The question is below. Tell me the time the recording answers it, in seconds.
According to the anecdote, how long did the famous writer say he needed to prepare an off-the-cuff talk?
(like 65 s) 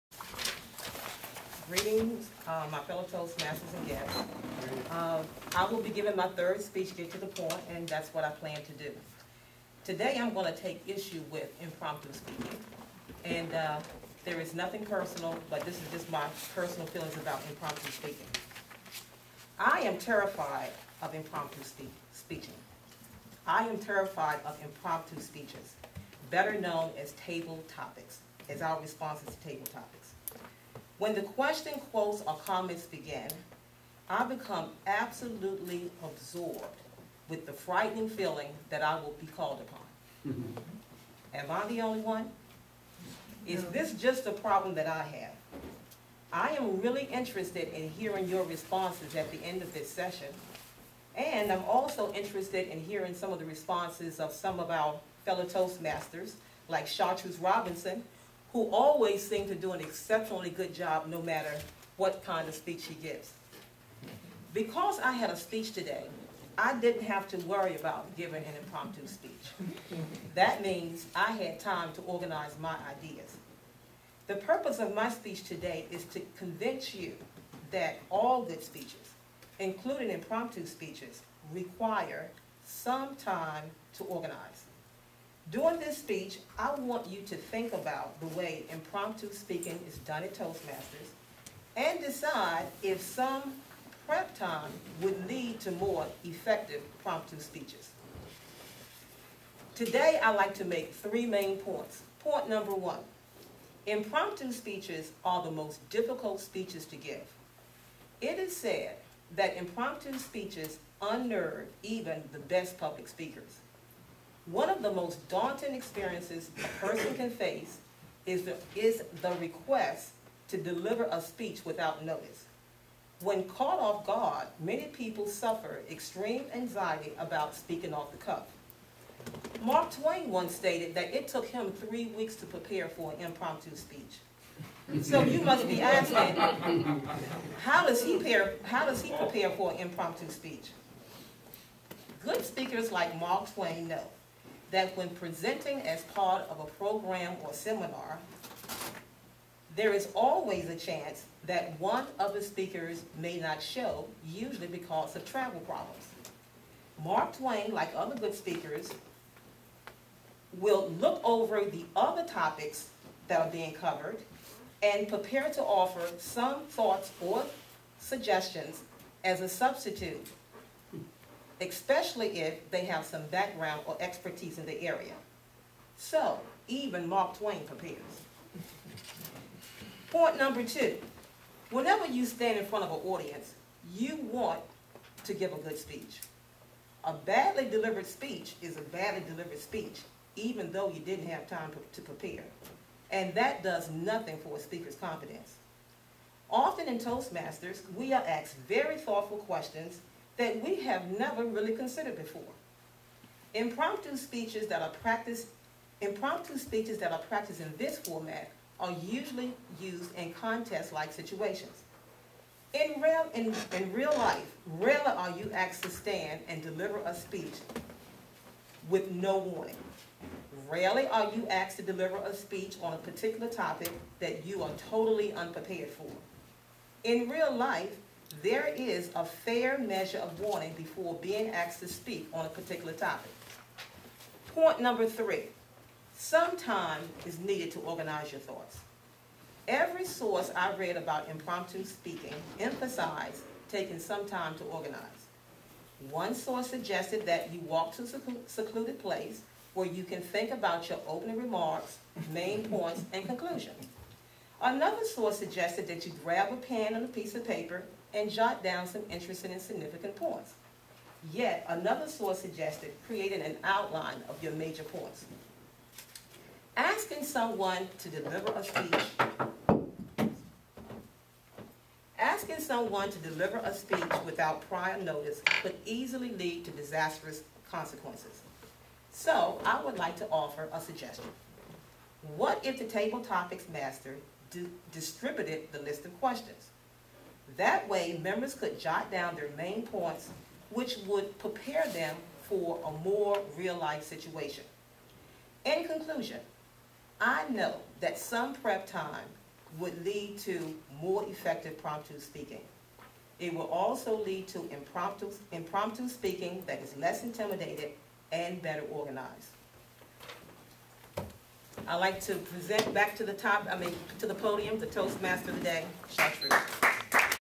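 131 s.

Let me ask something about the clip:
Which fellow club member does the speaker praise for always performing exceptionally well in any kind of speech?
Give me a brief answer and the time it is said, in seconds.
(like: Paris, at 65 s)
Chartreuse Robinson, at 56 s.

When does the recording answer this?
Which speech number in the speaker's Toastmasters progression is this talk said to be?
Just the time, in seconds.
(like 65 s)
6 s.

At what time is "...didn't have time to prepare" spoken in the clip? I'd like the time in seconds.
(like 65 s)
190 s.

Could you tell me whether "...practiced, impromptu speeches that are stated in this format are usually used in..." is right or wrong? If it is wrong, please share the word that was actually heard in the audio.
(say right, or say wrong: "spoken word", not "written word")
wrong: "practiced", not "stated".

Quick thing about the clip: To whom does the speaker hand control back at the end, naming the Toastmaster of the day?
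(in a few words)
Shastri.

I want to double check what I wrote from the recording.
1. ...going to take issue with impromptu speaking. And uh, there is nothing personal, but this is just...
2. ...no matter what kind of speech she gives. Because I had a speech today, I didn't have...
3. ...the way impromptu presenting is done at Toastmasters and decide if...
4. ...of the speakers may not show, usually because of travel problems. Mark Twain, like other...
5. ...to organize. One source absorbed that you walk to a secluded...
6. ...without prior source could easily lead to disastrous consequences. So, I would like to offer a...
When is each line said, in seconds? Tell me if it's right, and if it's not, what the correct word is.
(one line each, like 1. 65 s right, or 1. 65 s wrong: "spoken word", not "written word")
1. 10 s right
2. 61 s right
3. 88 s wrong: "speaking", not "presenting"
4. 152 s right
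5. 244 s wrong: "suggested", not "absorbed"
6. 274 s wrong: "notice", not "source".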